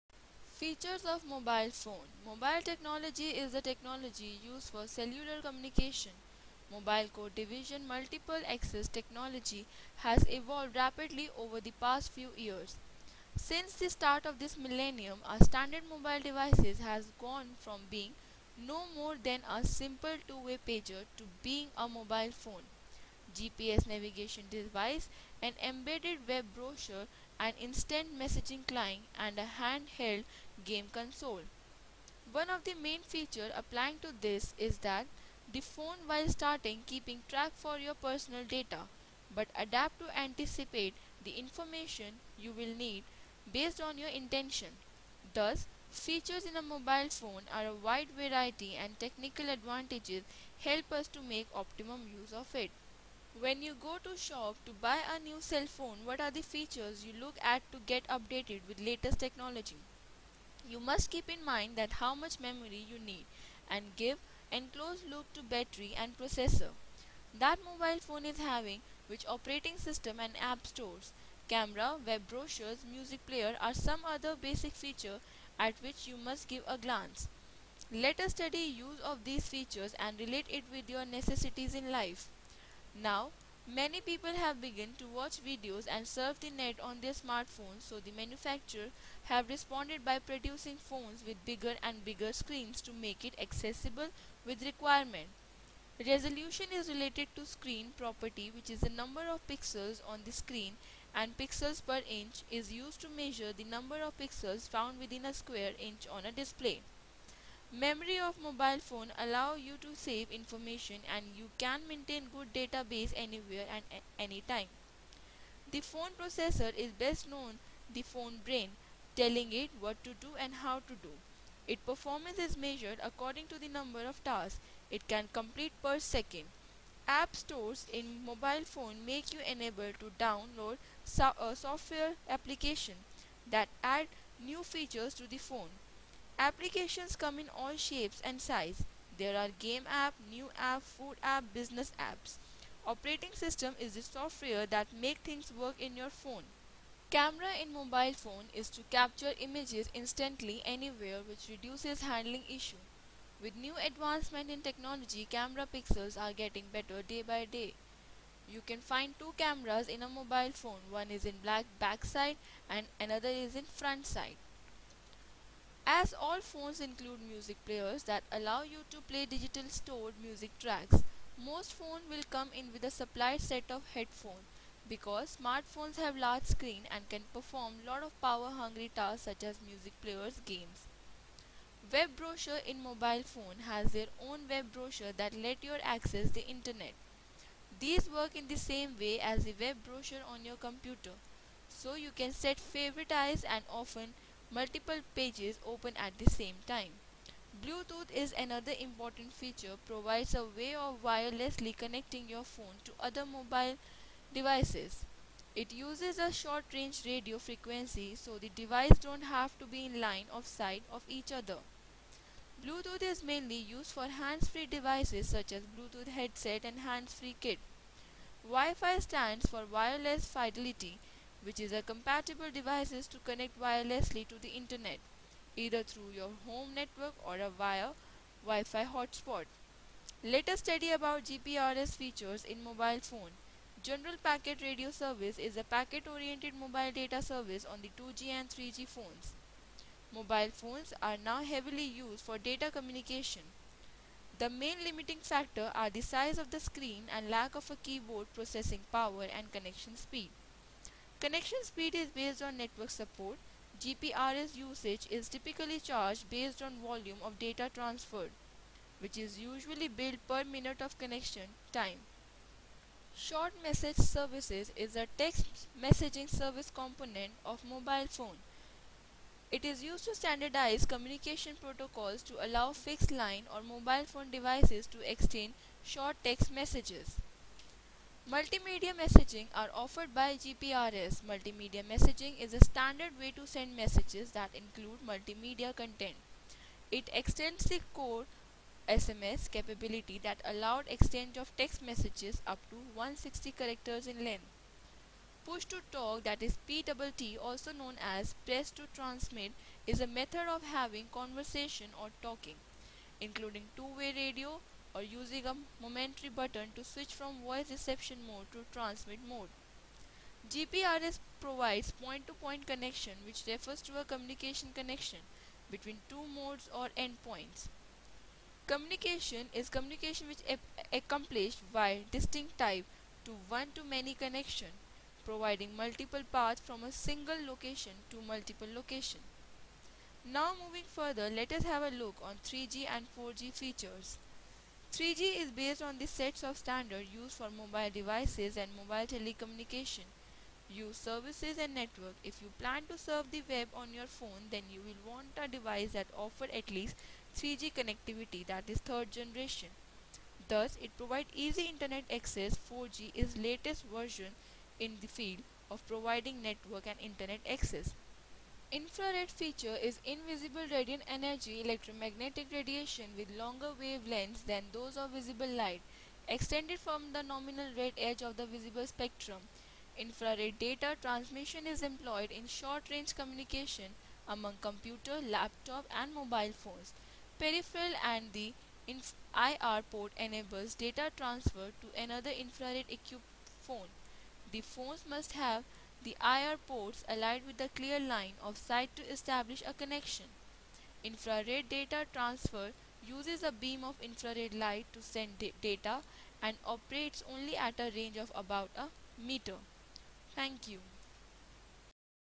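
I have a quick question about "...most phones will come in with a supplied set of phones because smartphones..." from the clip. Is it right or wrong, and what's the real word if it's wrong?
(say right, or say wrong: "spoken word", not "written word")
wrong: "headphones", not "phones".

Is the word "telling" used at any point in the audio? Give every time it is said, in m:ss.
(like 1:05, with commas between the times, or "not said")
1:59.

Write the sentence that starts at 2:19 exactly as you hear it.
There are game app, new app, food app, business apps.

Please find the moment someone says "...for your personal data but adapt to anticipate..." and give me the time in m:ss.
0:37.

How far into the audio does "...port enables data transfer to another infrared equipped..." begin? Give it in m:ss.
6:19.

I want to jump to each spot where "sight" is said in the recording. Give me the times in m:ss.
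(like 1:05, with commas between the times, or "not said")
3:30, 6:28.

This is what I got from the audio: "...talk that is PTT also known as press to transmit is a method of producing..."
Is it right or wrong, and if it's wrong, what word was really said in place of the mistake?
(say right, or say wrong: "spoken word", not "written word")
wrong: "having", not "producing".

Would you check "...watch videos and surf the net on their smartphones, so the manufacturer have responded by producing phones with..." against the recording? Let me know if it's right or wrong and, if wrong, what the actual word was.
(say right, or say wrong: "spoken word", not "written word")
right.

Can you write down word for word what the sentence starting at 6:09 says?
Infrared data transmission is employed in short-range communication among computer, laptop and mobile phones.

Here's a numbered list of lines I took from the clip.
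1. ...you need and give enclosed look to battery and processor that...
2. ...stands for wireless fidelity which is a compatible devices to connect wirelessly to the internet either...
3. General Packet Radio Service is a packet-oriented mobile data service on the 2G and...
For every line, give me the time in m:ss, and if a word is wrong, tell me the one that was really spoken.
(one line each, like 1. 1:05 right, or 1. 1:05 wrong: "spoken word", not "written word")
1. 1:02 right
2. 3:38 right
3. 3:53 right.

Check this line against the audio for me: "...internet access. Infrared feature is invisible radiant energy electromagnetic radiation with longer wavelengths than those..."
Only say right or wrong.
right.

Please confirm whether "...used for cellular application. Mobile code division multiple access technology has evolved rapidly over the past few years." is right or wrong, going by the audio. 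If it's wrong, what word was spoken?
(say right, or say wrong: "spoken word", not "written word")
wrong: "communication", not "application".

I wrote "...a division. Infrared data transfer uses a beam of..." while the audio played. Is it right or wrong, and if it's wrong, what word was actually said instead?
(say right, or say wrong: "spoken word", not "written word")
wrong: "connection", not "division".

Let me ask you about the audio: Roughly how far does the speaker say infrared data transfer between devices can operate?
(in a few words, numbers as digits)
About a meter.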